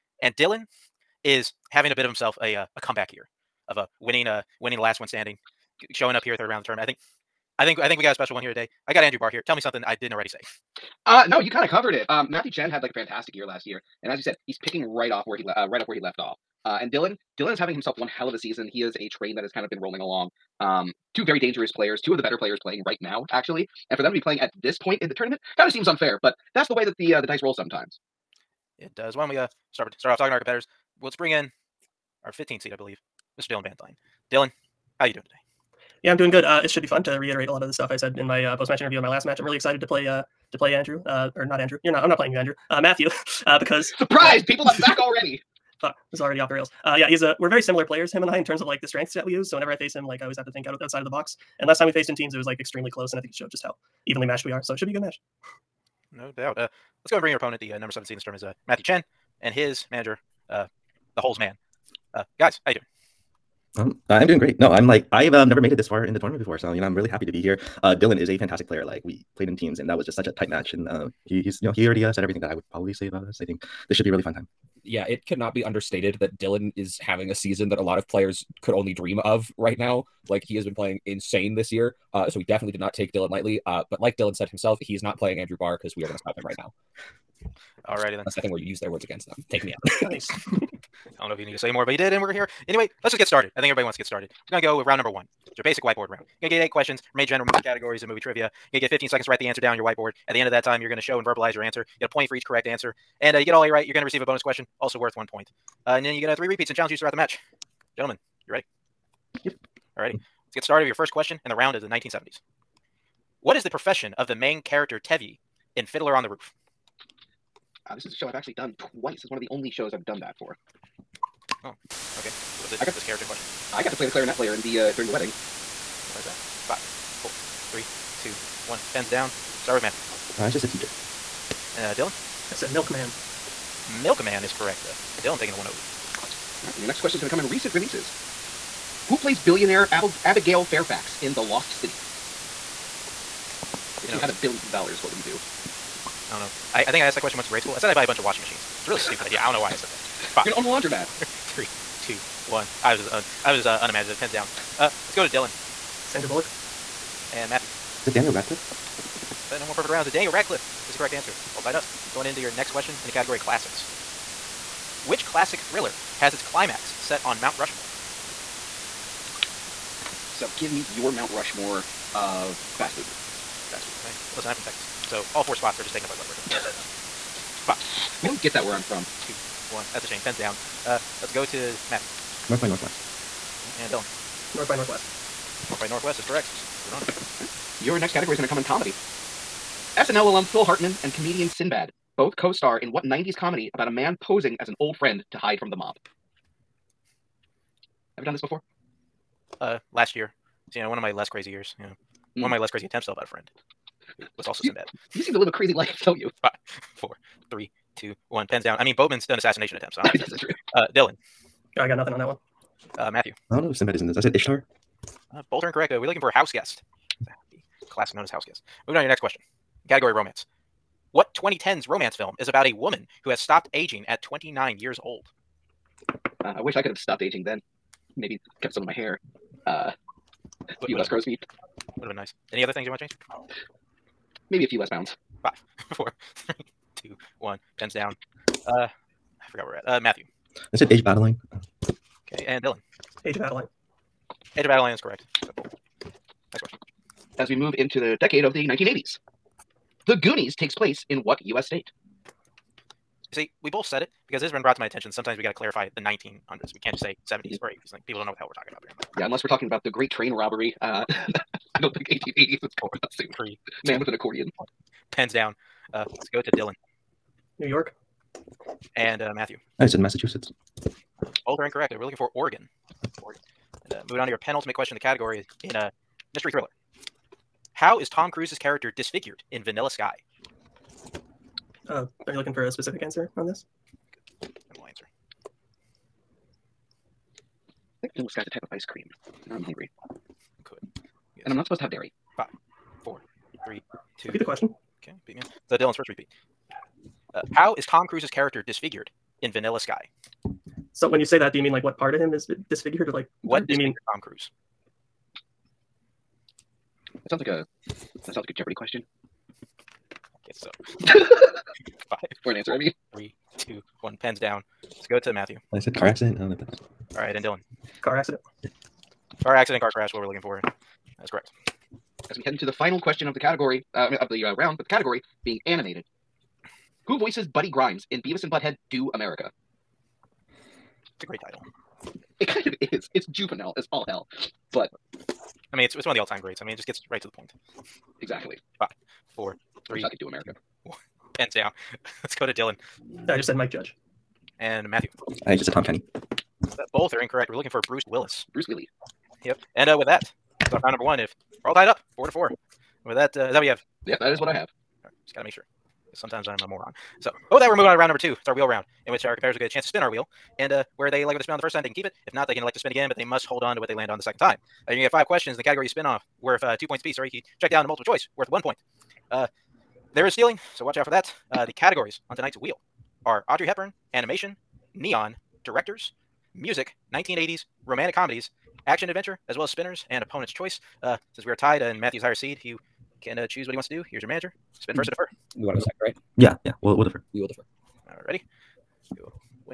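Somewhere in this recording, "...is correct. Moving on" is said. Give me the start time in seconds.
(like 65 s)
186 s.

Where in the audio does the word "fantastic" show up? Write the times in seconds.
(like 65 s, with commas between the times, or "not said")
12 s, 68 s.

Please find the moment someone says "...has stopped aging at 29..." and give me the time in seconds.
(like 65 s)
223 s.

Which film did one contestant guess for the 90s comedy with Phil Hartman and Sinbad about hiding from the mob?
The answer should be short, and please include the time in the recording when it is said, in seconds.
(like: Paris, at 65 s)
Ishtar, at 214 s.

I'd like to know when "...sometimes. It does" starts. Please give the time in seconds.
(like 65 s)
27 s.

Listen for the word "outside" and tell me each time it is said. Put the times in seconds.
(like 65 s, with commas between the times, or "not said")
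50 s.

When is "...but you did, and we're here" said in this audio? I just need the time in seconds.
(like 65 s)
91 s.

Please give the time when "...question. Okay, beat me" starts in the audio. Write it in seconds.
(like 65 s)
294 s.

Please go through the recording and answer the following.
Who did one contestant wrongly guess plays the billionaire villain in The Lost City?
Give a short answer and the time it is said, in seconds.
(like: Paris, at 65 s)
Sandra Bullock, at 156 s.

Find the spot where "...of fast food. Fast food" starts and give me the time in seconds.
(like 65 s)
172 s.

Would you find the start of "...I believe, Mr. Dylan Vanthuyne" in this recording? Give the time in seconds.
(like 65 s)
32 s.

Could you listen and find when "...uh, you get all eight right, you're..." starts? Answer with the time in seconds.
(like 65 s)
103 s.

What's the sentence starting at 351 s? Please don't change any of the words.
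If we're all tied up, four to four.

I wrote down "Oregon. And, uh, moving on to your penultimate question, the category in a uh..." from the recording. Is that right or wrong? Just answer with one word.
right.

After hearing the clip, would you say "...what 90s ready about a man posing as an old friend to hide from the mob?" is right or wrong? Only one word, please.
wrong.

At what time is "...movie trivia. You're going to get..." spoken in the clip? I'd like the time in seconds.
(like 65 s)
98 s.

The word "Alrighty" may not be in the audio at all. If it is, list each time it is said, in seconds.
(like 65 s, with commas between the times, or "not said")
87 s, 388 s.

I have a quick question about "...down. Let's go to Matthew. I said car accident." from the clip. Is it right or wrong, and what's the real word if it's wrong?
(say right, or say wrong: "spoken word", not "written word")
right.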